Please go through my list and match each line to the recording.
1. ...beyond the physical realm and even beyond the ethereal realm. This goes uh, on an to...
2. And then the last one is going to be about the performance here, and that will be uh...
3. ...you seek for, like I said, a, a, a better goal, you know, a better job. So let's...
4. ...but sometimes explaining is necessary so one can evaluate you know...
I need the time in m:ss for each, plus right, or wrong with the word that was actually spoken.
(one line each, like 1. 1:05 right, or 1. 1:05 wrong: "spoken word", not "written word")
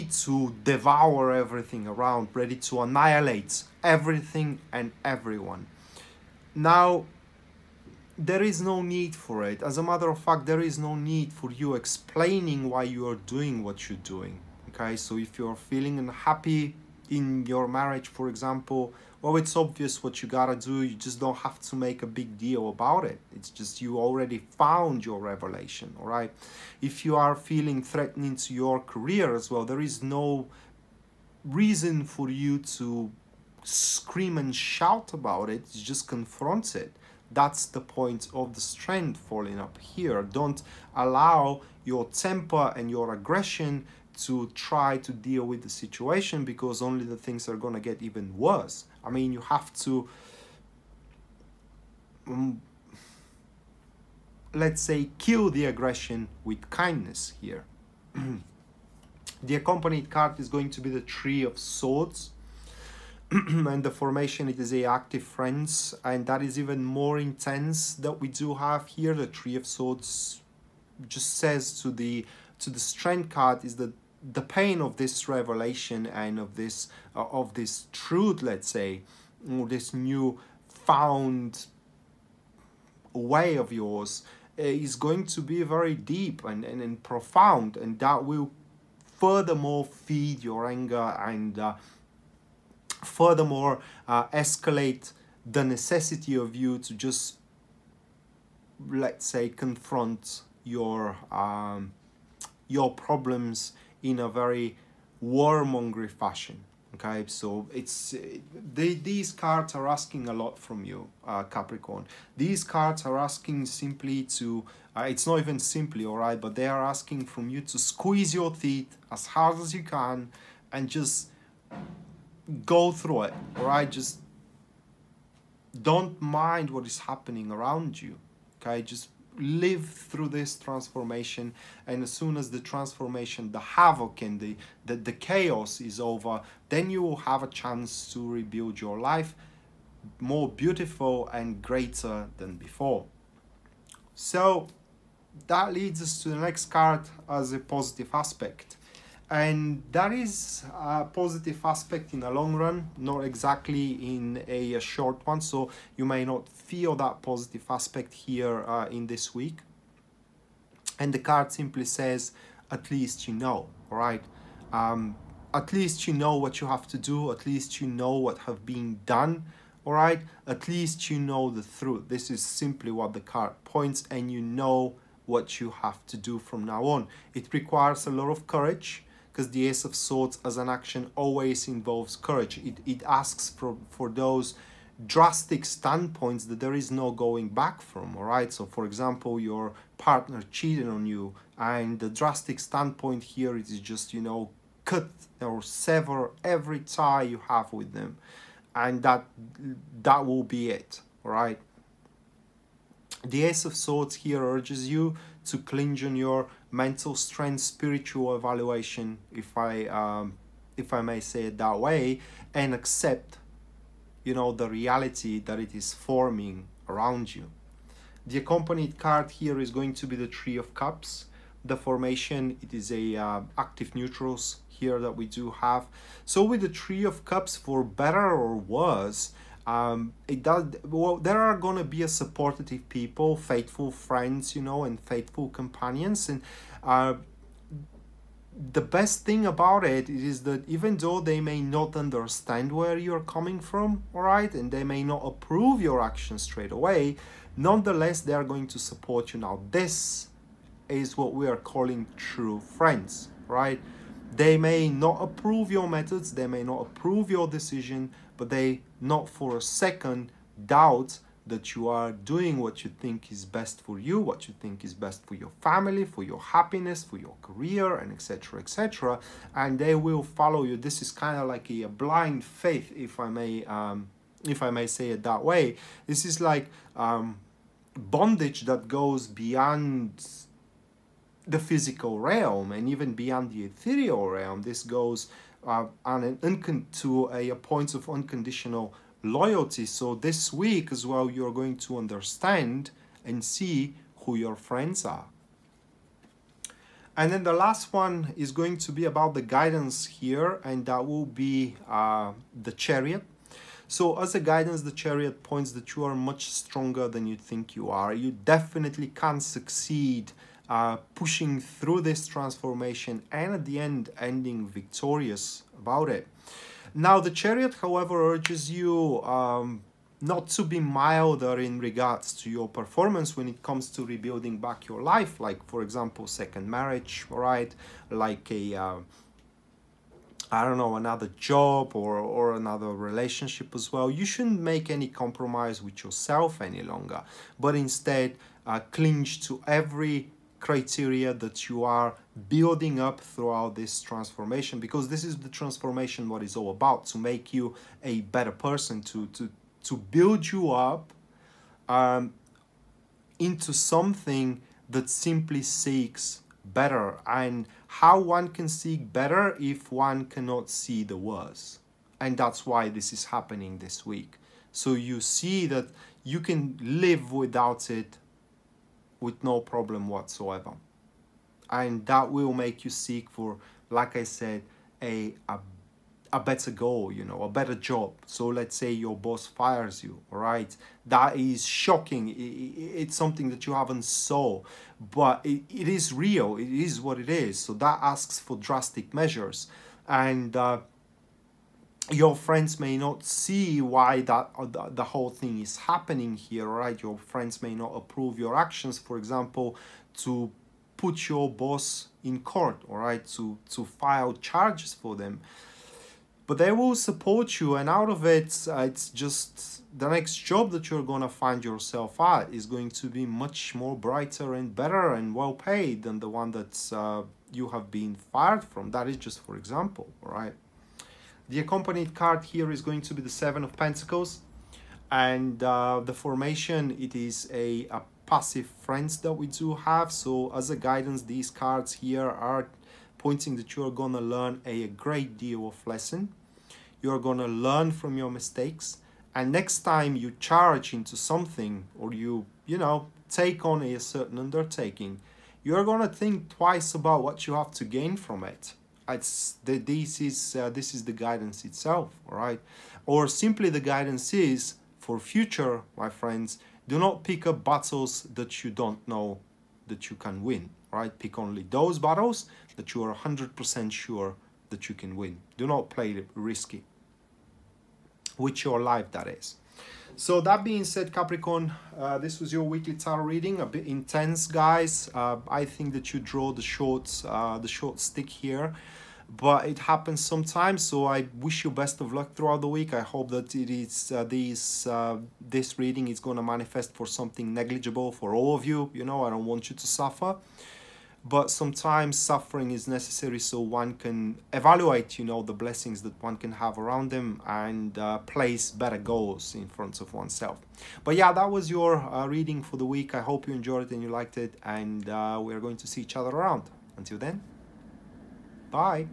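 1. 4:39 right
2. 4:57 wrong: "guidance", not "performance"
3. 6:12 right
4. 8:11 wrong: "suffering", not "explaining".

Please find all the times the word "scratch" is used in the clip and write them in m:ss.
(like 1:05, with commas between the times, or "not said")
not said.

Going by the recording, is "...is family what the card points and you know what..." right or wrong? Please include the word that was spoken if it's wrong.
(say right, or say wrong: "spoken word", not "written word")
wrong: "simply", not "family".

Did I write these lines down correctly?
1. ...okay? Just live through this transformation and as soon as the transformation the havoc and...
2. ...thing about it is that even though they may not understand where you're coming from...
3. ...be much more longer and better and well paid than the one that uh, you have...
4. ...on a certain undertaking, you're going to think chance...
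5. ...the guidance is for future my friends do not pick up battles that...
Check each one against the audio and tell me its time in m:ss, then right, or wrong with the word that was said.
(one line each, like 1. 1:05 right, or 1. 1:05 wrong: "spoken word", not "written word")
1. 2:08 right
2. 3:59 right
3. 6:53 wrong: "brighter", not "longer"
4. 7:23 wrong: "twice", not "chance"
5. 7:33 right.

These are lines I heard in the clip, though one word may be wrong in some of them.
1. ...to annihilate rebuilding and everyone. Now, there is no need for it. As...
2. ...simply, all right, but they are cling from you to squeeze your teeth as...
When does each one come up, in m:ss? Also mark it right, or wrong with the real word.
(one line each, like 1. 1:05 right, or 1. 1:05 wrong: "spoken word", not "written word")
1. 0:02 wrong: "everything", not "rebuilding"
2. 1:55 wrong: "asking", not "cling".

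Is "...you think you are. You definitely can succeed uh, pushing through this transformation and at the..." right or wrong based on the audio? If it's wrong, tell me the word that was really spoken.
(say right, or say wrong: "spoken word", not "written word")
right.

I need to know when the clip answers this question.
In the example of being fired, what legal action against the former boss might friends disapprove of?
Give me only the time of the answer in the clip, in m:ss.
6:40.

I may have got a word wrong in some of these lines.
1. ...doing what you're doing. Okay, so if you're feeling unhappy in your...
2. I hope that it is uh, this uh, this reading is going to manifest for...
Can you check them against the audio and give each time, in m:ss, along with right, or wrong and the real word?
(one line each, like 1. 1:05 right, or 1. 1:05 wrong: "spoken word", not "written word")
1. 0:13 right
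2. 8:02 right.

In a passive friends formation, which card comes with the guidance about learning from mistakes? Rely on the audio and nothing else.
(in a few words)
Seven of Pentacles.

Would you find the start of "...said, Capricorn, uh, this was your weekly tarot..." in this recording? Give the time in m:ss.
7:50.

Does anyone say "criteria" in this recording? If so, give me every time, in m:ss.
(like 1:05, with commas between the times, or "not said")
5:40.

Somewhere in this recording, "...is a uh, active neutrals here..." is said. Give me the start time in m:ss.
3:42.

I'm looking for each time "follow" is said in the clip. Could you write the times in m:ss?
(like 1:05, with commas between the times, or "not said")
4:30.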